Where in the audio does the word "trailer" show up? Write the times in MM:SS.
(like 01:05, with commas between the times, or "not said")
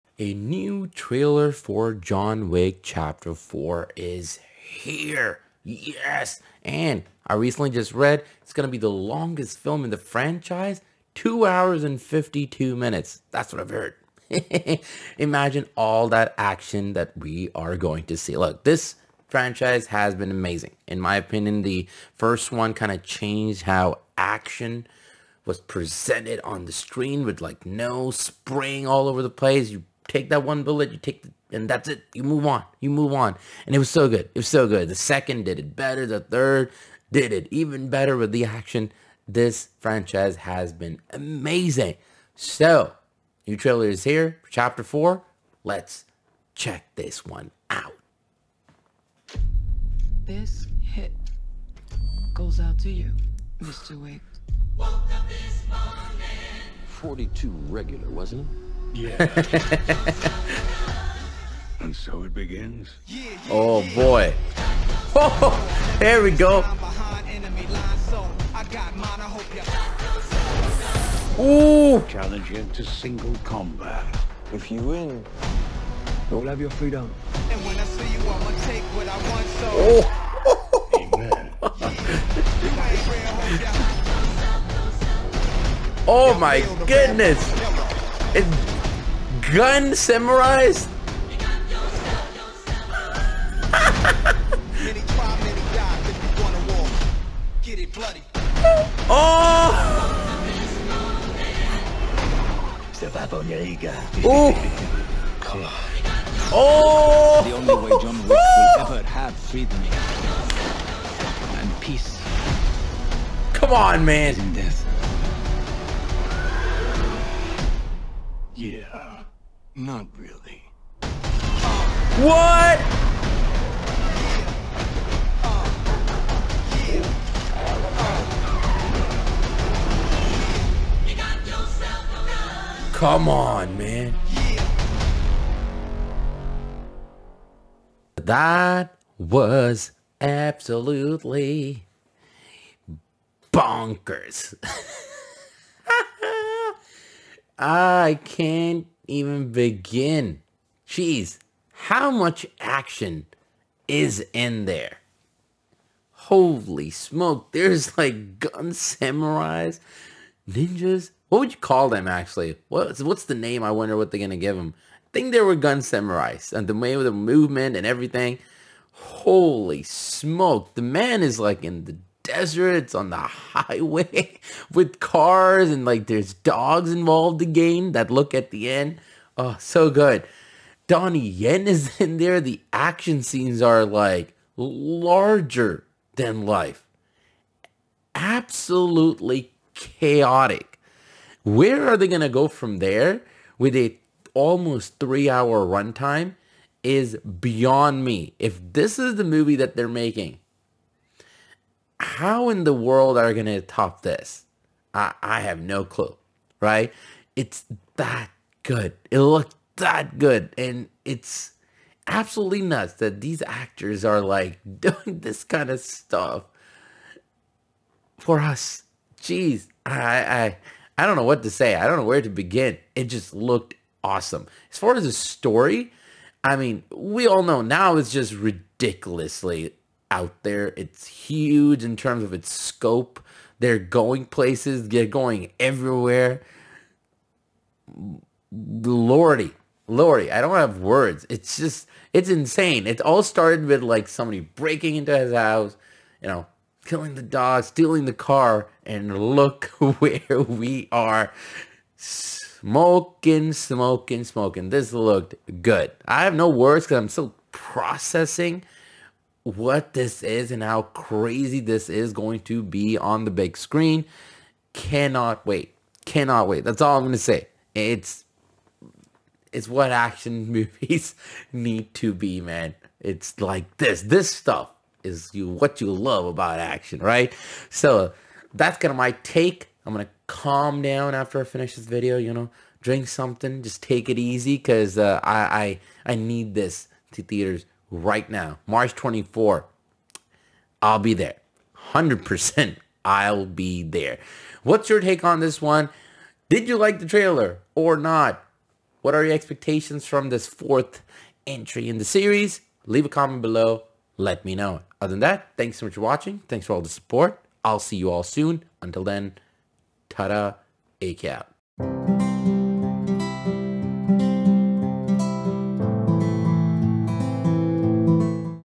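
00:00, 00:43, 04:57.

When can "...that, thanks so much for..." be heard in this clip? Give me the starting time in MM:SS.
05:05.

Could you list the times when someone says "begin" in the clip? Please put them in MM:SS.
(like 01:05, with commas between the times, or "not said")
01:02, 02:29, 03:42.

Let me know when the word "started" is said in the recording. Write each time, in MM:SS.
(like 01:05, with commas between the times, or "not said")
04:03.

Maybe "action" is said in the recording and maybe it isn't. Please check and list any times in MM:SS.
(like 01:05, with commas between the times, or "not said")
00:16, 00:24, 00:38, 02:32, 03:02, 04:29, 04:36.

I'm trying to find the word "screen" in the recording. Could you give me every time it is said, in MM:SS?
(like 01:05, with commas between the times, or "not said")
00:26, 04:23.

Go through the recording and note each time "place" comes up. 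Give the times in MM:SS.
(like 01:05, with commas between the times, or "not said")
00:29, 03:54.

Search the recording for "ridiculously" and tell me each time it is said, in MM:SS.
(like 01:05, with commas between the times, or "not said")
03:48.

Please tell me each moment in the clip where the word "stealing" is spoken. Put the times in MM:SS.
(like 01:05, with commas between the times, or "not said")
04:07.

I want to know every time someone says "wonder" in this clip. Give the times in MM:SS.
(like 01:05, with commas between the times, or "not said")
02:43.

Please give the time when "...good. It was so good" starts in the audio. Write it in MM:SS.
00:34.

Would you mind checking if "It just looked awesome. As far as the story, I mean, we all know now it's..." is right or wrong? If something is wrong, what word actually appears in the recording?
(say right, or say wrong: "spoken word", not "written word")
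right.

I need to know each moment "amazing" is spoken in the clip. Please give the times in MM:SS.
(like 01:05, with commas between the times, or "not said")
00:20, 00:41.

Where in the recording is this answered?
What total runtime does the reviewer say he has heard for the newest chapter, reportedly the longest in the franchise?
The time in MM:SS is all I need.
00:11.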